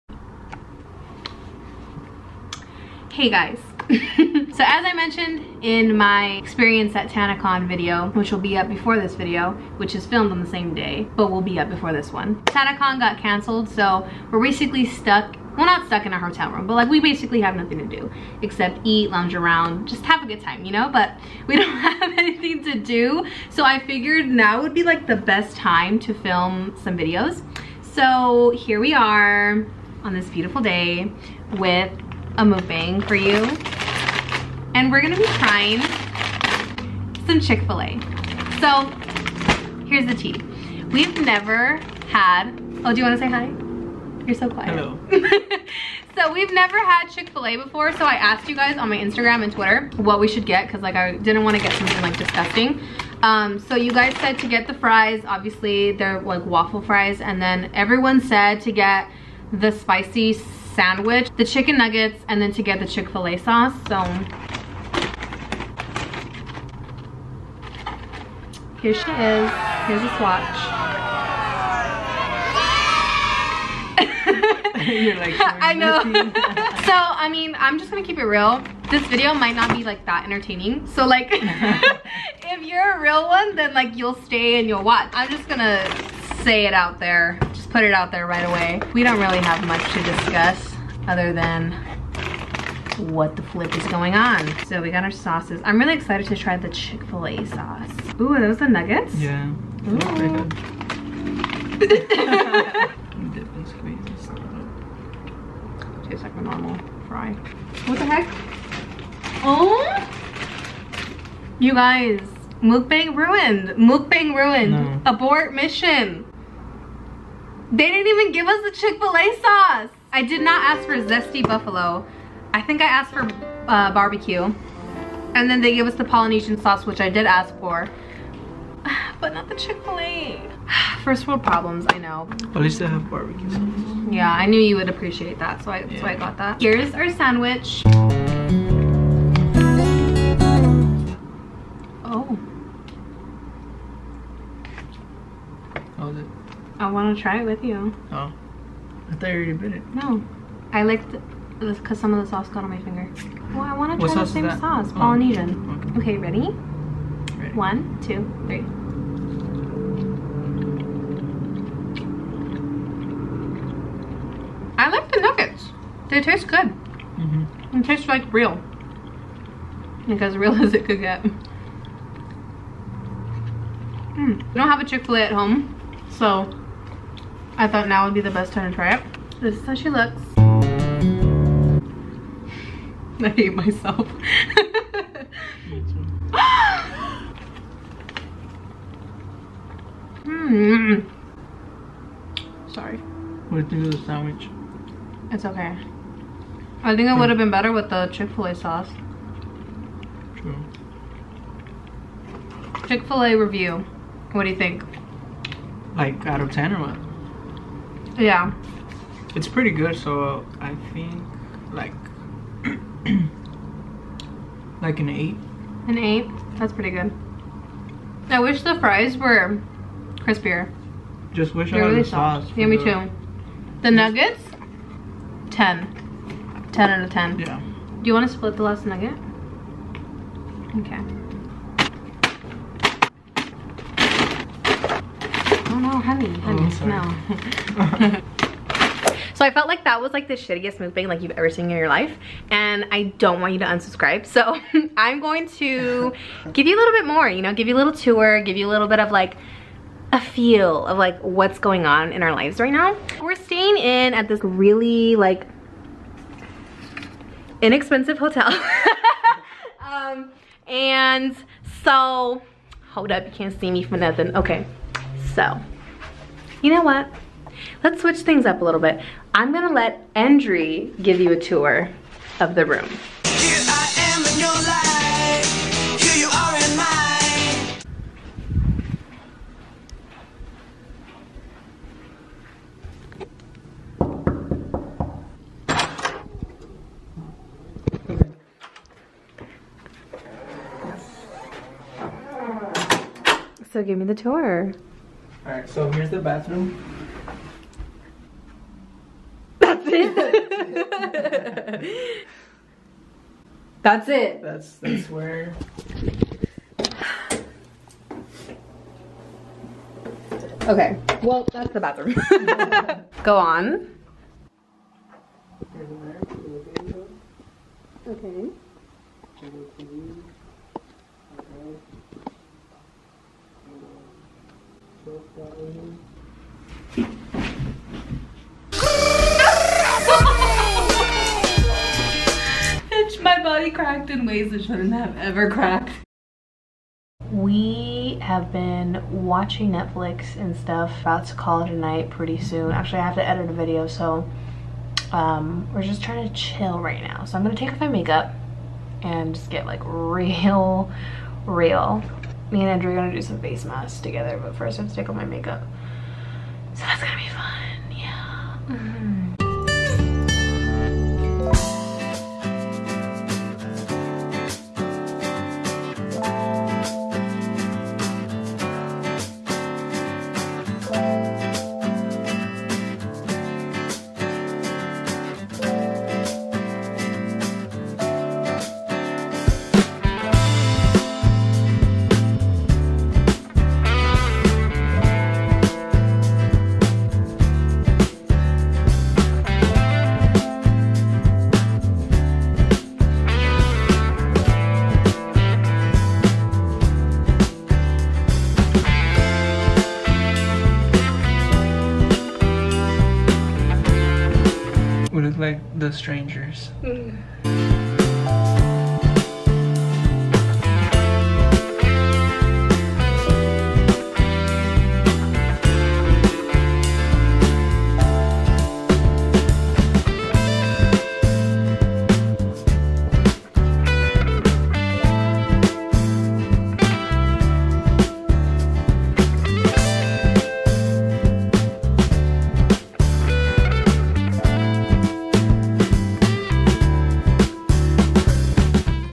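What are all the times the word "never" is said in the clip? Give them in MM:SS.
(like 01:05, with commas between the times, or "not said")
00:41, 00:46.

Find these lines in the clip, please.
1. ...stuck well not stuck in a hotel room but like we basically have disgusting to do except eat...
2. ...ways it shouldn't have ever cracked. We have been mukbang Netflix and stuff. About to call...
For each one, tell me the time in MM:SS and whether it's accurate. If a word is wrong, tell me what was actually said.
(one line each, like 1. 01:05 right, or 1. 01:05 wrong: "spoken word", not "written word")
1. 00:14 wrong: "nothing", not "disgusting"
2. 05:34 wrong: "watching", not "mukbang".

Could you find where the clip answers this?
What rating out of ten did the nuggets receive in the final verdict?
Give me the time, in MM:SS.
03:46.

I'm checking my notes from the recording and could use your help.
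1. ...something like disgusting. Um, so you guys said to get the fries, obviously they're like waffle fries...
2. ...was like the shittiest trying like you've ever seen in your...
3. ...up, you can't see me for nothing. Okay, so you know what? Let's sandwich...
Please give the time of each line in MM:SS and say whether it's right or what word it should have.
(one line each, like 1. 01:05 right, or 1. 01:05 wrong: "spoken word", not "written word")
1. 00:51 right
2. 03:59 wrong: "mukbang", not "trying"
3. 04:23 wrong: "switch", not "sandwich".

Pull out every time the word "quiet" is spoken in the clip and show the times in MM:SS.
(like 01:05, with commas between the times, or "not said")
00:44.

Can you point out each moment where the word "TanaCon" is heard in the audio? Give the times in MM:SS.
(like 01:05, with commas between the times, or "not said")
00:07, 00:12.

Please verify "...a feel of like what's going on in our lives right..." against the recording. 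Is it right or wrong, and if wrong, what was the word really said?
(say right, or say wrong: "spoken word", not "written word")
right.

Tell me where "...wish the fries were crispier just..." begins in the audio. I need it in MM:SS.
03:38.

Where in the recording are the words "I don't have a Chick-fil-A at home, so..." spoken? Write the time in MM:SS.
02:54.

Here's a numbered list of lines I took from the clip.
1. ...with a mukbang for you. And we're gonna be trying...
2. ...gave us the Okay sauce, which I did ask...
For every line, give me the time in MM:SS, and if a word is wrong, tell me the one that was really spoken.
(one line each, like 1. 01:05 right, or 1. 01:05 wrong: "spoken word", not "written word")
1. 00:31 right
2. 02:05 wrong: "Polynesian", not "Okay".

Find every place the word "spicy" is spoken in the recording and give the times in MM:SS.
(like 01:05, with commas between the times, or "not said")
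00:59.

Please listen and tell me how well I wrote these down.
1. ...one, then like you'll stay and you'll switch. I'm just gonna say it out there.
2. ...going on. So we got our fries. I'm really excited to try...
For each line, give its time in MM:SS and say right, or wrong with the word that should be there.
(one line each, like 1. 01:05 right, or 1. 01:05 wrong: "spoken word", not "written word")
1. 01:23 wrong: "watch", not "switch"
2. 01:33 wrong: "sauces", not "fries".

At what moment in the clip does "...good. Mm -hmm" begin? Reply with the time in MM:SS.
02:46.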